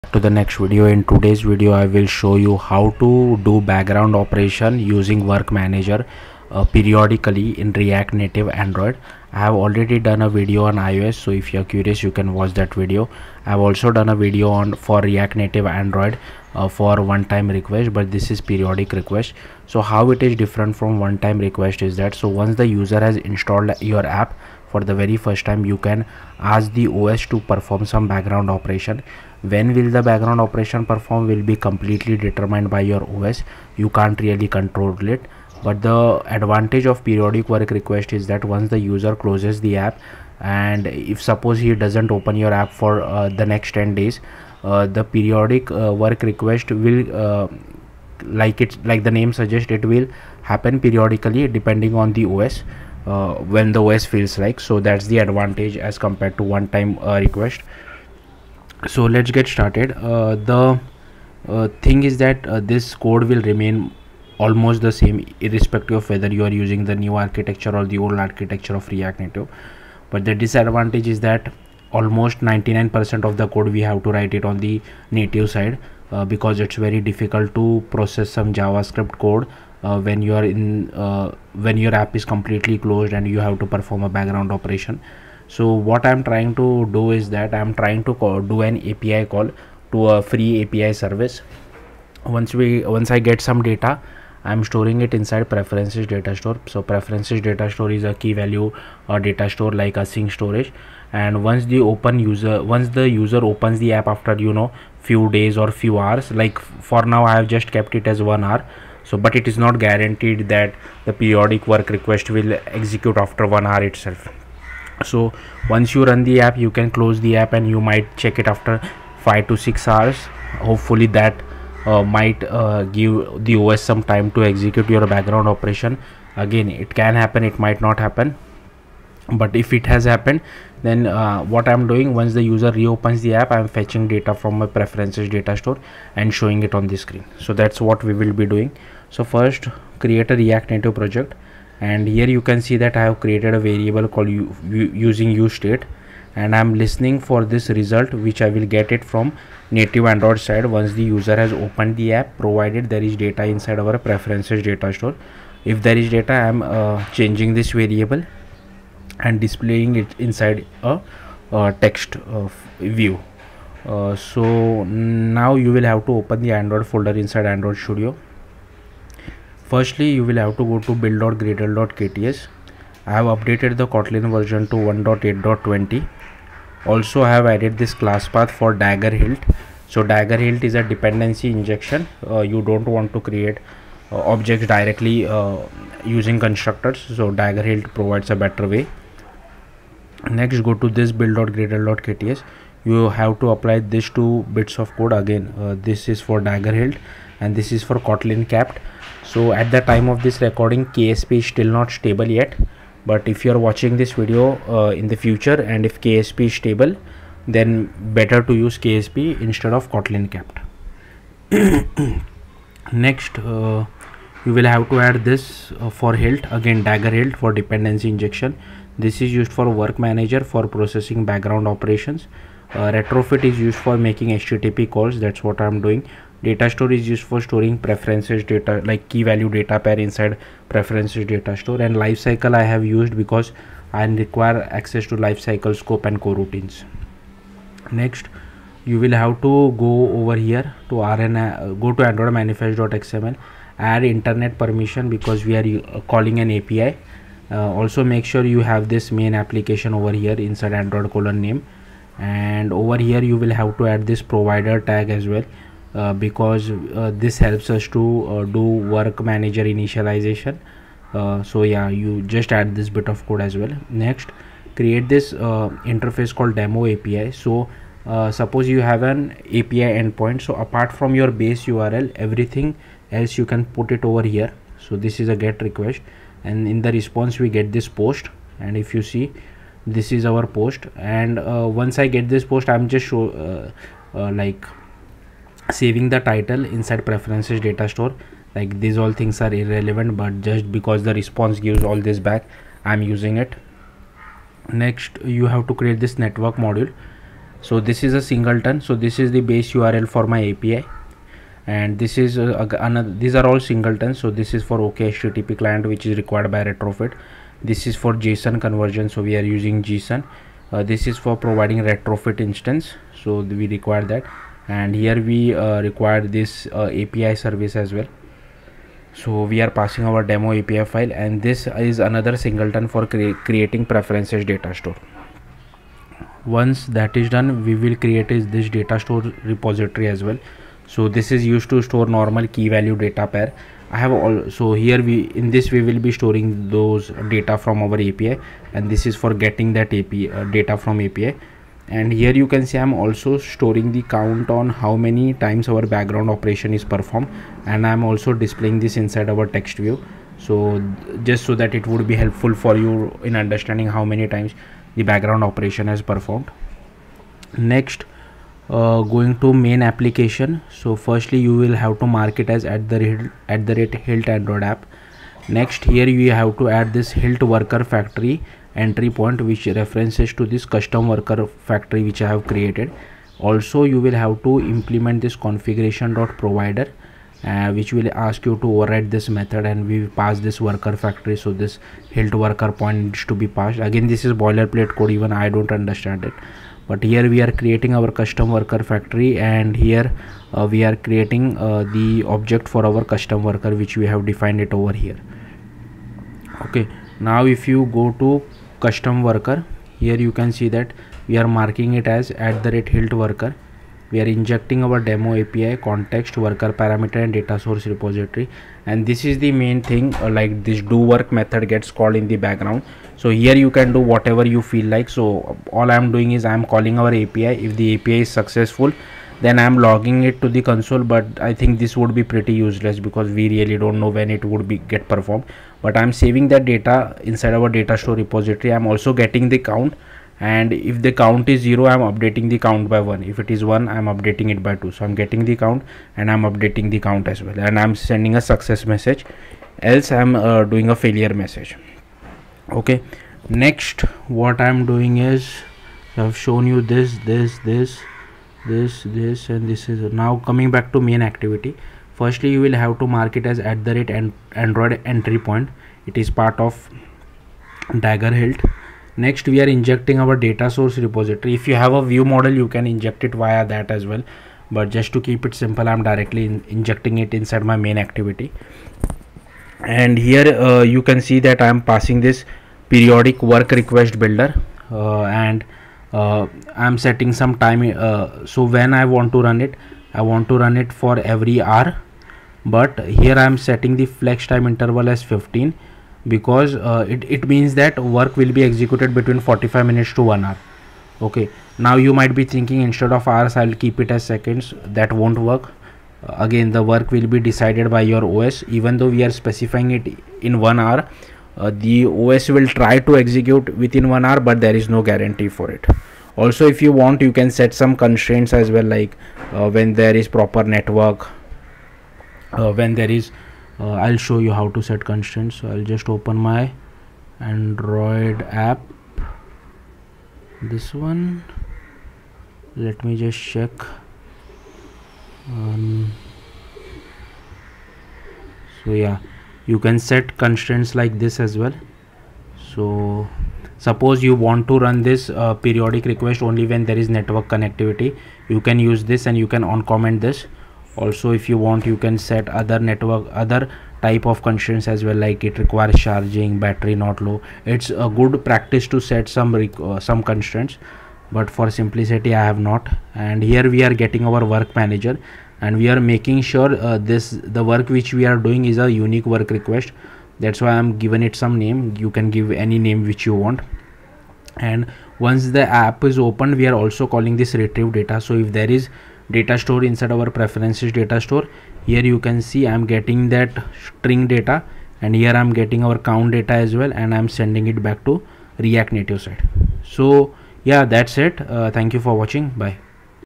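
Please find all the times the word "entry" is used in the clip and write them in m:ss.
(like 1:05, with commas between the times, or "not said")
6:08, 7:35.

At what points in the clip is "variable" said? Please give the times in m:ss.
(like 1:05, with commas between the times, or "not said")
2:23, 2:37.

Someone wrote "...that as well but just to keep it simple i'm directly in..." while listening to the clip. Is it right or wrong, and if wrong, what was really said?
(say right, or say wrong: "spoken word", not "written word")
right.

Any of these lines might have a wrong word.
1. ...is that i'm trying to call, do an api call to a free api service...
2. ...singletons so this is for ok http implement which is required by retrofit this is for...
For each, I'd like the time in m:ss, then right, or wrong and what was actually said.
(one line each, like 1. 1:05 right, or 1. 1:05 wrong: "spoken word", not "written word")
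1. 1:27 right
2. 5:03 wrong: "client", not "implement".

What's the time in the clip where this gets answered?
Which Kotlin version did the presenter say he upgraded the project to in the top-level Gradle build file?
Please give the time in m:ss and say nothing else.
2:54.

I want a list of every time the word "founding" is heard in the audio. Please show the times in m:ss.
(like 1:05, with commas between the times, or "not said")
not said.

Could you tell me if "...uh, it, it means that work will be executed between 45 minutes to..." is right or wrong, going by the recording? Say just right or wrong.
right.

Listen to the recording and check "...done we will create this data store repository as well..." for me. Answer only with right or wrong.
right.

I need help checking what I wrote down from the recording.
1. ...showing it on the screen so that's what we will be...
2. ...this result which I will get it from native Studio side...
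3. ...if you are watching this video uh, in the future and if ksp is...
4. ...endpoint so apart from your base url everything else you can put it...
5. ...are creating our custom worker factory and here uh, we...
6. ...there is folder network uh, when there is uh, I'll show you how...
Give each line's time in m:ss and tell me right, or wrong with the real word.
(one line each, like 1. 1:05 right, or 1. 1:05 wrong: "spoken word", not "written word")
1. 2:16 right
2. 2:27 wrong: "Android", not "Studio"
3. 3:23 right
4. 4:29 right
5. 6:27 right
6. 8:29 wrong: "proper", not "folder".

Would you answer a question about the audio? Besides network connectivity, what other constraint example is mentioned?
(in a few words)
requires charging.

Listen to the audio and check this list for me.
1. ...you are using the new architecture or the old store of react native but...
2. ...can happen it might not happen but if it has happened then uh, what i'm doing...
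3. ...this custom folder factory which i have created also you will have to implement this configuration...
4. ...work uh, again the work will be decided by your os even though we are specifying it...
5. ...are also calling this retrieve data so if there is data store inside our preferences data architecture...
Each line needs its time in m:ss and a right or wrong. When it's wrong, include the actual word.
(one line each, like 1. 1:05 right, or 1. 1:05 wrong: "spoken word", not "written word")
1. 1:06 wrong: "architecture", not "store"
2. 2:06 right
3. 6:10 wrong: "worker", not "folder"
4. 8:15 right
5. 9:26 wrong: "store", not "architecture".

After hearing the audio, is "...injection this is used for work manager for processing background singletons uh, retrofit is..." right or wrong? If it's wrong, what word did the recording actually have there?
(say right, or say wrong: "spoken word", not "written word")
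wrong: "operations", not "singletons".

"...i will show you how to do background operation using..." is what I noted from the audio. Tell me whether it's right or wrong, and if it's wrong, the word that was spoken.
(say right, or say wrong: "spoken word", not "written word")
right.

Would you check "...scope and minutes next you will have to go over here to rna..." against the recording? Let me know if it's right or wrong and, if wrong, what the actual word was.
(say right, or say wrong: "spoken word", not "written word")
wrong: "coroutines", not "minutes".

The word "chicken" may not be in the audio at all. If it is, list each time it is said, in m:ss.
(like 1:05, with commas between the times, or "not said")
not said.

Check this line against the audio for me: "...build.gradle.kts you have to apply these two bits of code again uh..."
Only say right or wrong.
right.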